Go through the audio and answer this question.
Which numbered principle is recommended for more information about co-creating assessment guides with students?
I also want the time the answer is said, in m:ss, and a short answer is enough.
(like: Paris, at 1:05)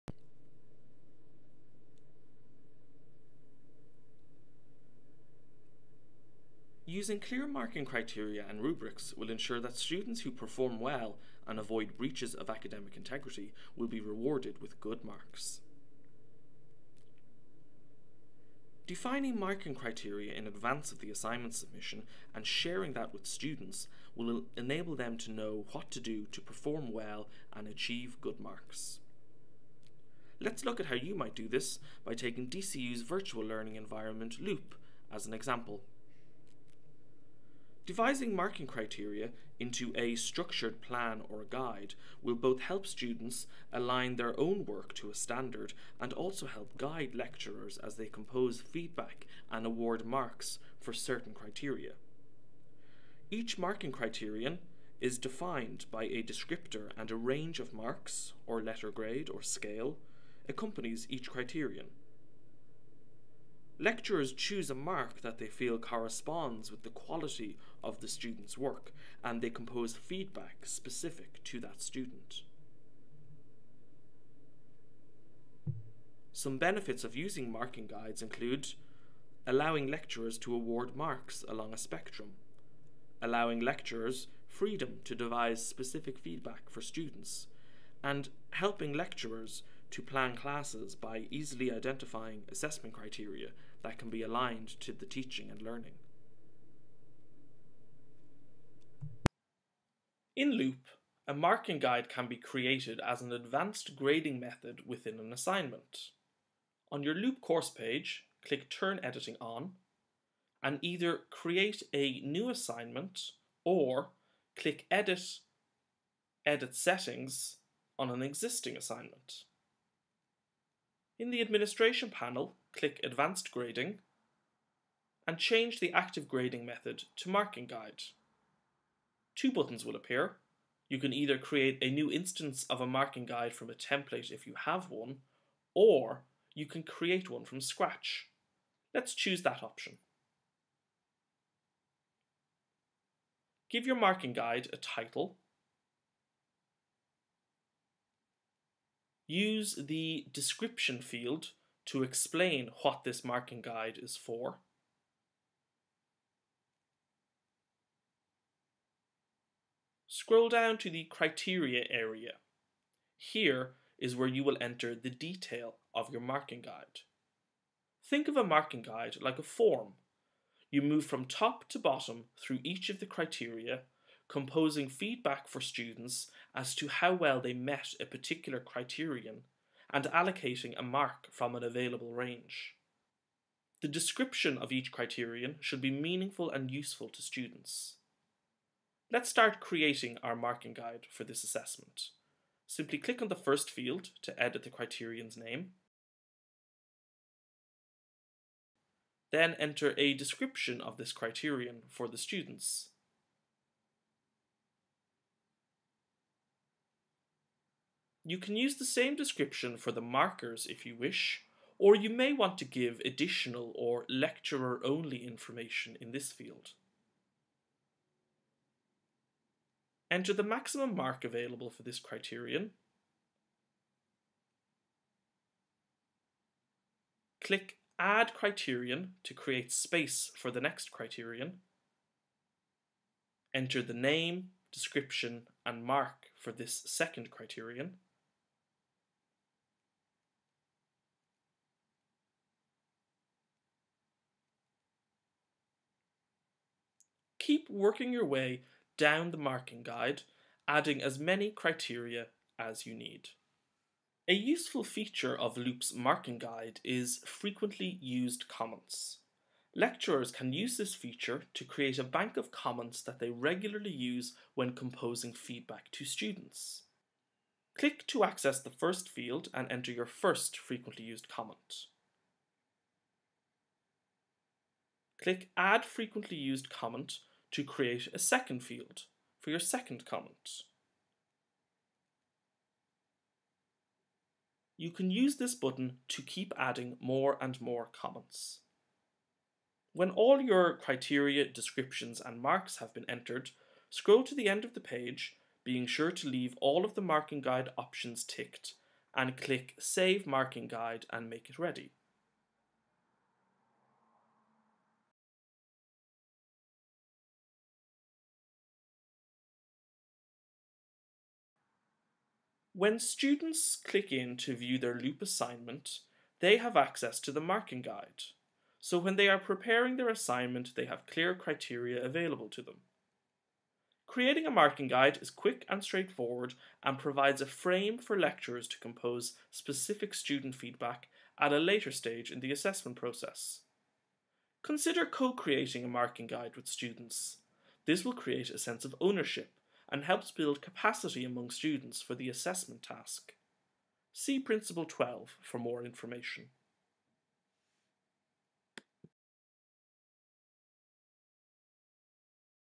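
Principle 12, at 5:44.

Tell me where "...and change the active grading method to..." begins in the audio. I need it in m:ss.
2:05.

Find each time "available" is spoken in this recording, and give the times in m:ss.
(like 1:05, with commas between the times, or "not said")
3:01, 3:41, 5:22.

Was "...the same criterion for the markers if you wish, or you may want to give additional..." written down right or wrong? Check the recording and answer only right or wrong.
wrong.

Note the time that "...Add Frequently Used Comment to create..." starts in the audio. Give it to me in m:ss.
4:35.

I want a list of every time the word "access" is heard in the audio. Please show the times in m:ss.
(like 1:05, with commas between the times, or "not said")
4:28, 5:16.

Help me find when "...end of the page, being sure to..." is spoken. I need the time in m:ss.
4:54.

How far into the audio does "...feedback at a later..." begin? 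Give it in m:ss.
5:30.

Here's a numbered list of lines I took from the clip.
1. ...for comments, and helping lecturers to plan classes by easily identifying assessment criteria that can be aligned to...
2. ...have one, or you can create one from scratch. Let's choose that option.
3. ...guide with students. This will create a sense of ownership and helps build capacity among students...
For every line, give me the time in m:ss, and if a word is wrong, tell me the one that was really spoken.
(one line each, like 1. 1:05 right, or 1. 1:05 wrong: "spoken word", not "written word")
1. 1:26 wrong: "students", not "comments"
2. 2:14 right
3. 5:36 right.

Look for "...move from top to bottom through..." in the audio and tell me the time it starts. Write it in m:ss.
2:50.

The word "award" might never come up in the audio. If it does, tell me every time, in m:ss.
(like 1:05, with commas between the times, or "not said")
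0:49, 1:20.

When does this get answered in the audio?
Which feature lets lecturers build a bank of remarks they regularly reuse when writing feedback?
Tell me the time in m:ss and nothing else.
4:17.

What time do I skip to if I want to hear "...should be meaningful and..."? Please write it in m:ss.
3:05.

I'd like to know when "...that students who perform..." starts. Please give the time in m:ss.
0:09.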